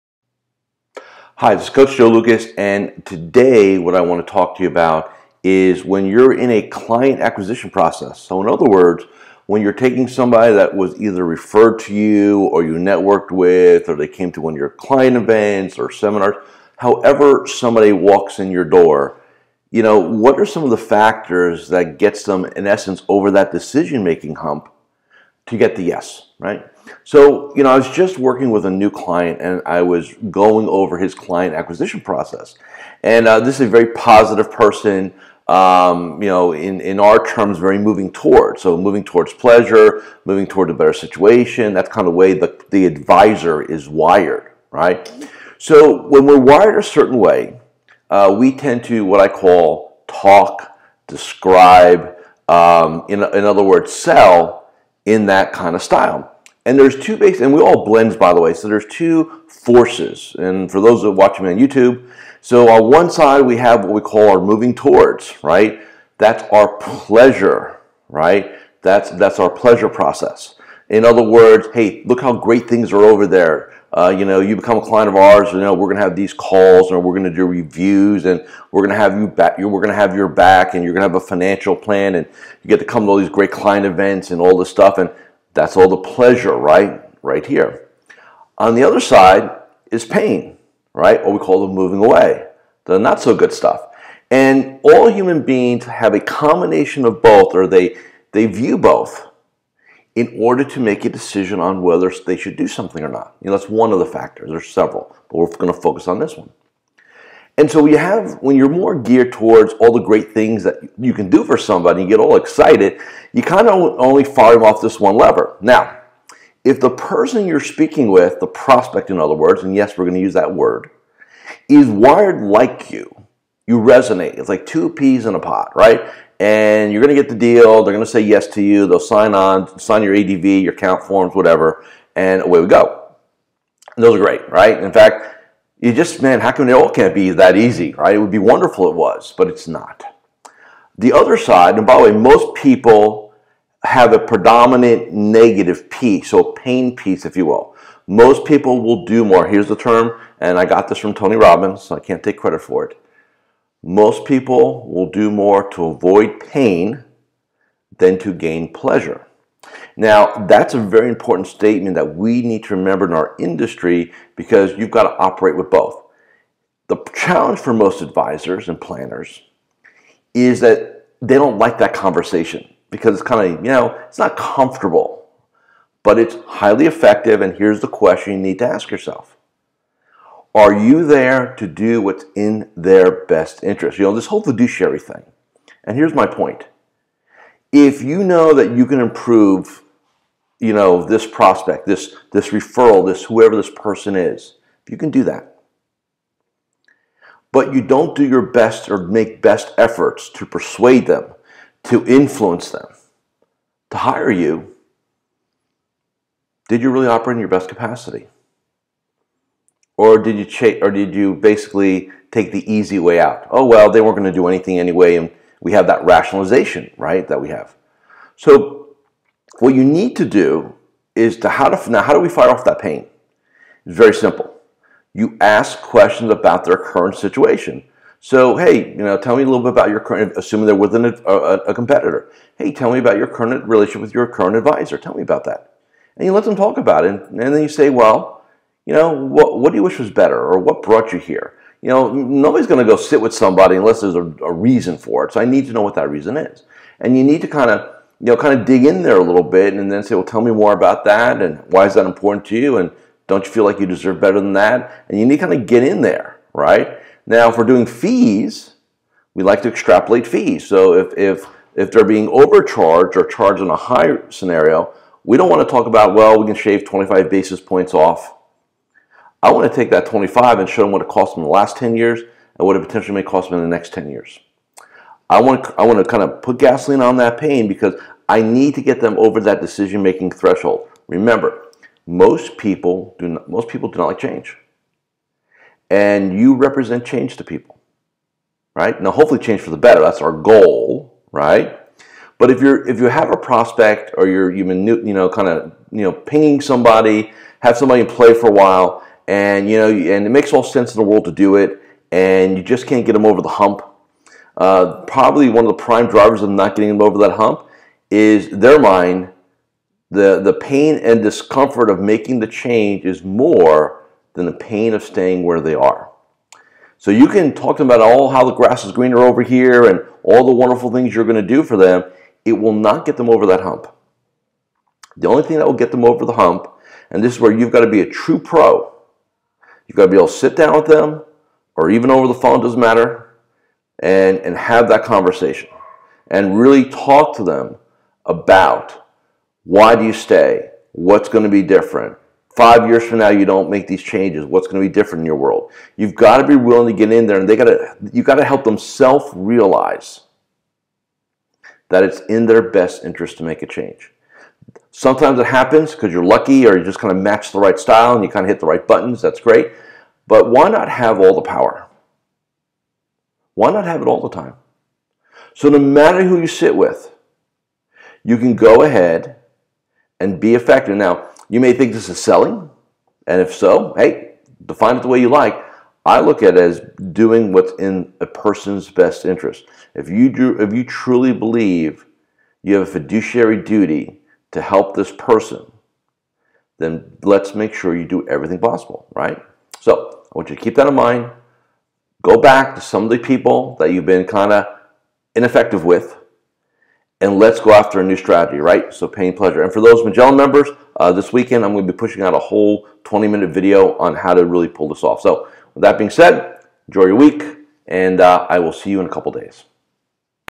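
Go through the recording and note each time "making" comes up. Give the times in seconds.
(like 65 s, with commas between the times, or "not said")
24 s, 279 s, 312 s.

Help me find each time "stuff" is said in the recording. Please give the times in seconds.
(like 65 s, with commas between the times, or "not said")
84 s, 93 s.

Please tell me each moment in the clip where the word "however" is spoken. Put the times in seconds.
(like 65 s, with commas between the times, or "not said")
16 s.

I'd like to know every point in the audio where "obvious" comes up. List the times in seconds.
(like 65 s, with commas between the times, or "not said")
not said.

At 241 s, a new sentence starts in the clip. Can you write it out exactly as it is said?
You know, nobody's going to go sit with somebody unless there's a, a, reason for it.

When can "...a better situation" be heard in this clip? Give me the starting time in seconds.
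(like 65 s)
40 s.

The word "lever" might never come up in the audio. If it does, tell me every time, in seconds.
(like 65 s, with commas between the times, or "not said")
115 s.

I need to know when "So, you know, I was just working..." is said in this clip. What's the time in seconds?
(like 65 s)
27 s.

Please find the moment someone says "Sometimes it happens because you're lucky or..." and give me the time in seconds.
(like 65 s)
354 s.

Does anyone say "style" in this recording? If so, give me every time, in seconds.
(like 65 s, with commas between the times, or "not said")
55 s, 357 s.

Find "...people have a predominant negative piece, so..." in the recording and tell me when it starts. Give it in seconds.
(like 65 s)
142 s.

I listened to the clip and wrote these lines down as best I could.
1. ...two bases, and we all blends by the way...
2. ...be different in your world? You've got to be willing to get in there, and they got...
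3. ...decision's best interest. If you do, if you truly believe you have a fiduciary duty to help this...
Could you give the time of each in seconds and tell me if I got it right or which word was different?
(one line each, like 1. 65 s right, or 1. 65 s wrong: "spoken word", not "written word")
1. 56 s right
2. 344 s right
3. 378 s wrong: "person", not "decision".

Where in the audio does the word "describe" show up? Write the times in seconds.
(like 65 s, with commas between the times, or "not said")
51 s.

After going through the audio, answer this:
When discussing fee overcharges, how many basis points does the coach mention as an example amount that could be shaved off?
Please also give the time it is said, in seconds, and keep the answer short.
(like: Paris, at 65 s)
25, at 266 s.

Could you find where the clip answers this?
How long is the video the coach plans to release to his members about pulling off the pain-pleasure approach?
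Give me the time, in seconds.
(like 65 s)
403 s.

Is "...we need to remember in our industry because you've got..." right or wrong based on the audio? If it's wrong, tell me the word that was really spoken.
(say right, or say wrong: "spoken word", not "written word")
right.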